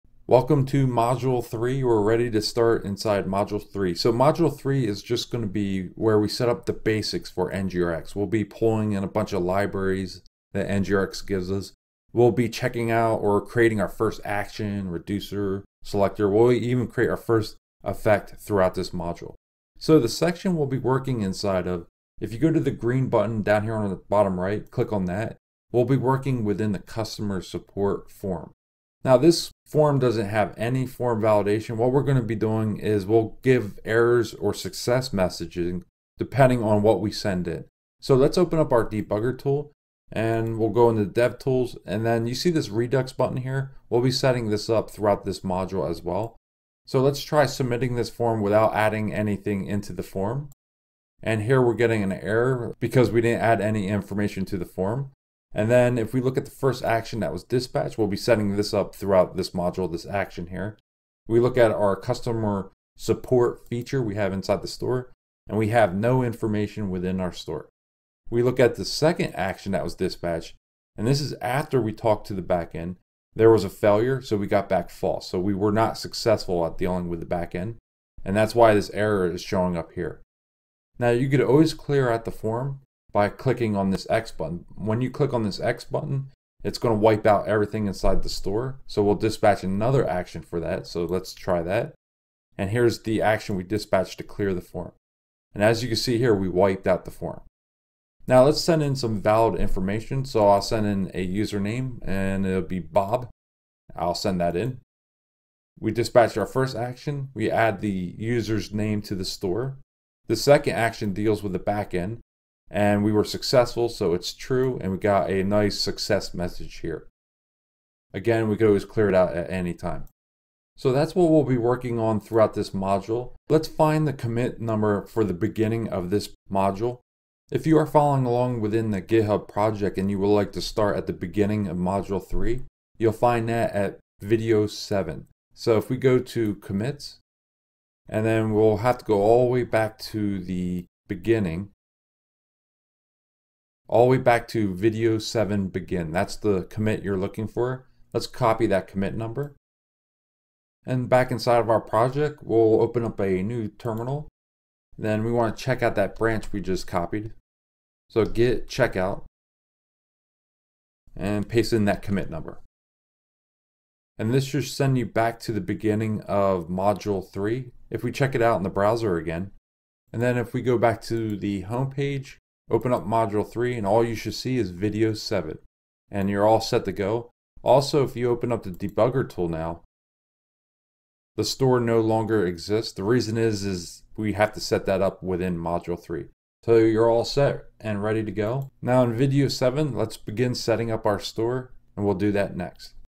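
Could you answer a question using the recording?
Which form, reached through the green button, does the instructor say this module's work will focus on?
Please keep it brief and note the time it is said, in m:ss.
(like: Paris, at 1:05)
Customer support form, at 0:26.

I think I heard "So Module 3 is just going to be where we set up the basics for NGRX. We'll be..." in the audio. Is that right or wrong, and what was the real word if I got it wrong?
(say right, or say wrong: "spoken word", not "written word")
right.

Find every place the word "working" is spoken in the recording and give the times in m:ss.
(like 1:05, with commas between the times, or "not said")
0:20, 0:25, 2:01.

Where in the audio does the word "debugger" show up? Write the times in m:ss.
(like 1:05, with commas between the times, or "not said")
0:38, 2:58.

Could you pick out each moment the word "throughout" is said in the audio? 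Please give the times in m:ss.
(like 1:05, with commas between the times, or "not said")
0:18, 0:44, 0:58, 2:02.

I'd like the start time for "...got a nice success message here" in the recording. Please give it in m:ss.
1:54.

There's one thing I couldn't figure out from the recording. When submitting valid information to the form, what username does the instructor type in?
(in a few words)
Bob.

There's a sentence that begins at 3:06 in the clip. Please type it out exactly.
So you're all set and ready to go.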